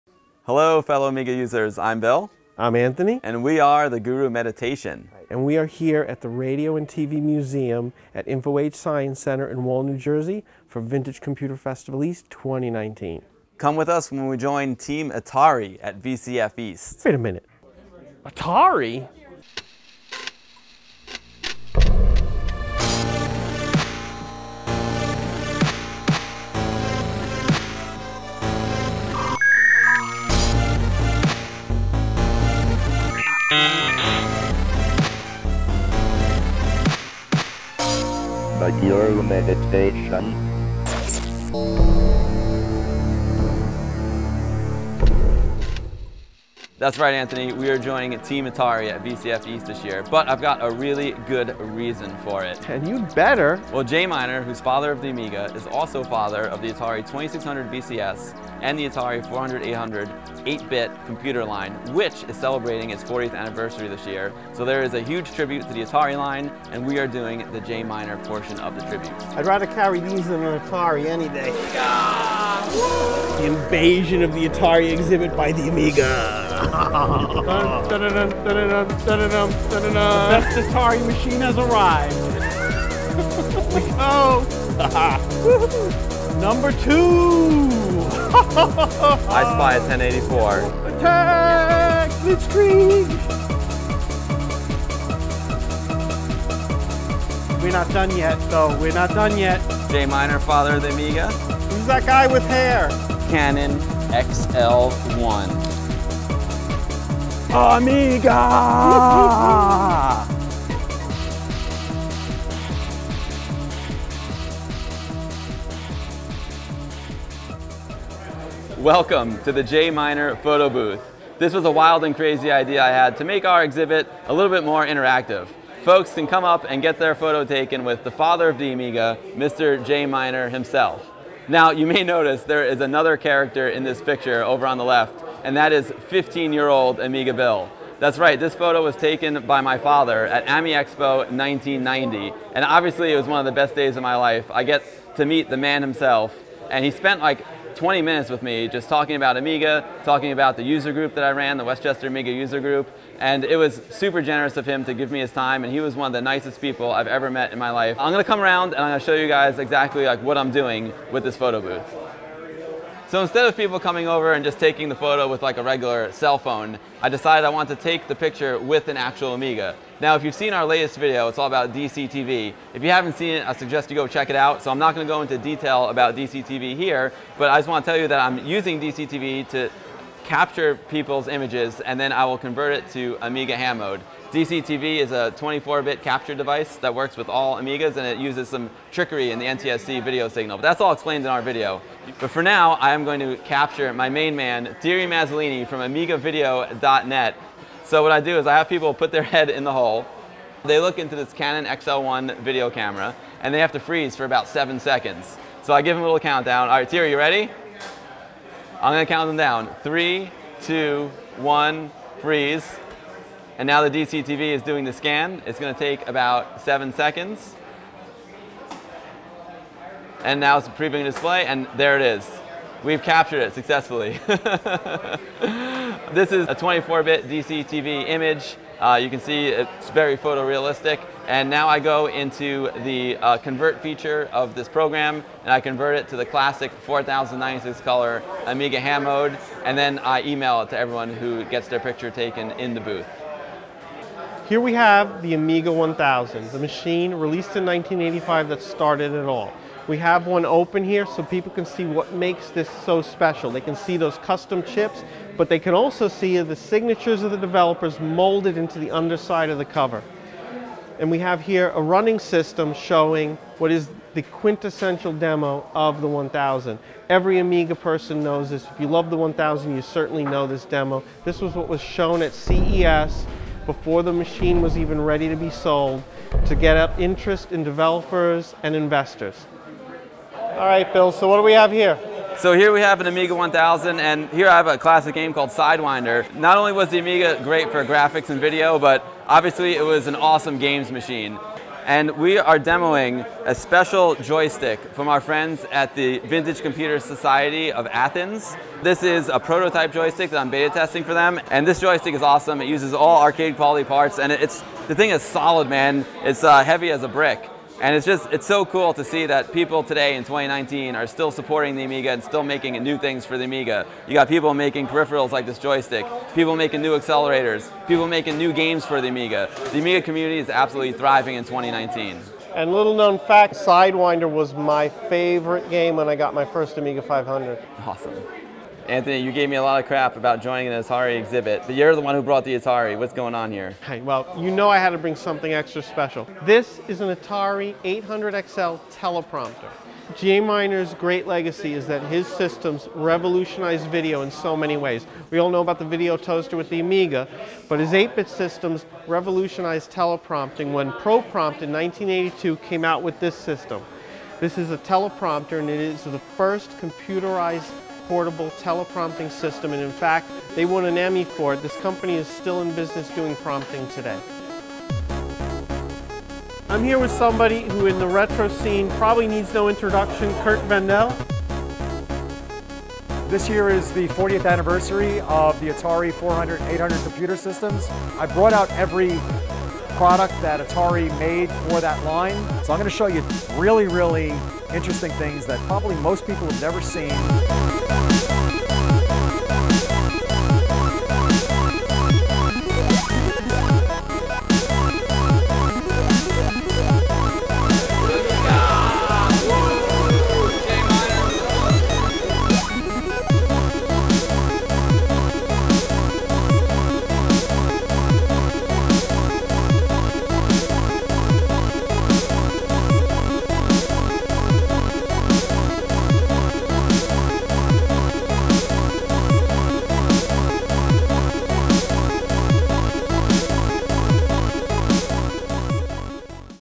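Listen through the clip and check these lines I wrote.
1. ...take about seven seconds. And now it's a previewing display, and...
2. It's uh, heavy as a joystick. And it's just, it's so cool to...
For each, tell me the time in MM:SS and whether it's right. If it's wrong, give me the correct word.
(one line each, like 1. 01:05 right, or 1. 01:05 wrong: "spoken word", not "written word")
1. 03:35 right
2. 05:06 wrong: "brick", not "joystick".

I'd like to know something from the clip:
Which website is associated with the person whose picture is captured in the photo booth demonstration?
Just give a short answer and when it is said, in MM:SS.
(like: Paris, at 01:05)
AmigaVideo.net, at 03:15.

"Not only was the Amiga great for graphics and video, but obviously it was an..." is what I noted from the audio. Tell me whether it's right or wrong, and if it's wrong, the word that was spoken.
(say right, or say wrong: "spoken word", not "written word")
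right.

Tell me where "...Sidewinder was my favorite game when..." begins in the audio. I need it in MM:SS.
05:23.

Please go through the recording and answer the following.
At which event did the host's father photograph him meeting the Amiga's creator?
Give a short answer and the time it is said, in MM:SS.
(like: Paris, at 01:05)
AMI Expo 1990, at 02:20.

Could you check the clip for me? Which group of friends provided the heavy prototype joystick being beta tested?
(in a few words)
Vintage Computer Society of Athens.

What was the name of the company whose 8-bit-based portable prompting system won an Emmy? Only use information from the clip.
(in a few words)
ProPrompt.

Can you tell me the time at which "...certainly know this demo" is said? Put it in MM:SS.
04:29.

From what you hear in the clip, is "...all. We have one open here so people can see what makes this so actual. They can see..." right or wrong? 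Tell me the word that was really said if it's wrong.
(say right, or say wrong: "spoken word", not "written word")
wrong: "special", not "actual".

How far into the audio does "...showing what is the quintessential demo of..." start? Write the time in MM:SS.
04:22.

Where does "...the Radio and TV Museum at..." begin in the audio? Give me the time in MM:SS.
00:06.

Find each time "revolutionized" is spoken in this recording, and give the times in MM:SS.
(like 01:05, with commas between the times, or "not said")
05:42, 05:49.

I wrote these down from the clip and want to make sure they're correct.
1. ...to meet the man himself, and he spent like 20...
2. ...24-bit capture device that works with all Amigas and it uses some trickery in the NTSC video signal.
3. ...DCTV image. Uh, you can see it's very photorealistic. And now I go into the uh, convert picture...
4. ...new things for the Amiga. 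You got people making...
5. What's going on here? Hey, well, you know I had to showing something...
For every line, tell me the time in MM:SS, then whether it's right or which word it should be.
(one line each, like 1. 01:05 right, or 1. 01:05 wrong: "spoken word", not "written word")
1. 02:25 right
2. 03:05 right
3. 03:47 wrong: "feature", not "picture"
4. 05:12 right
5. 05:32 wrong: "bring", not "showing".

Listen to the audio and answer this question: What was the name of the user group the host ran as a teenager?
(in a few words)
Westchester Amiga user group.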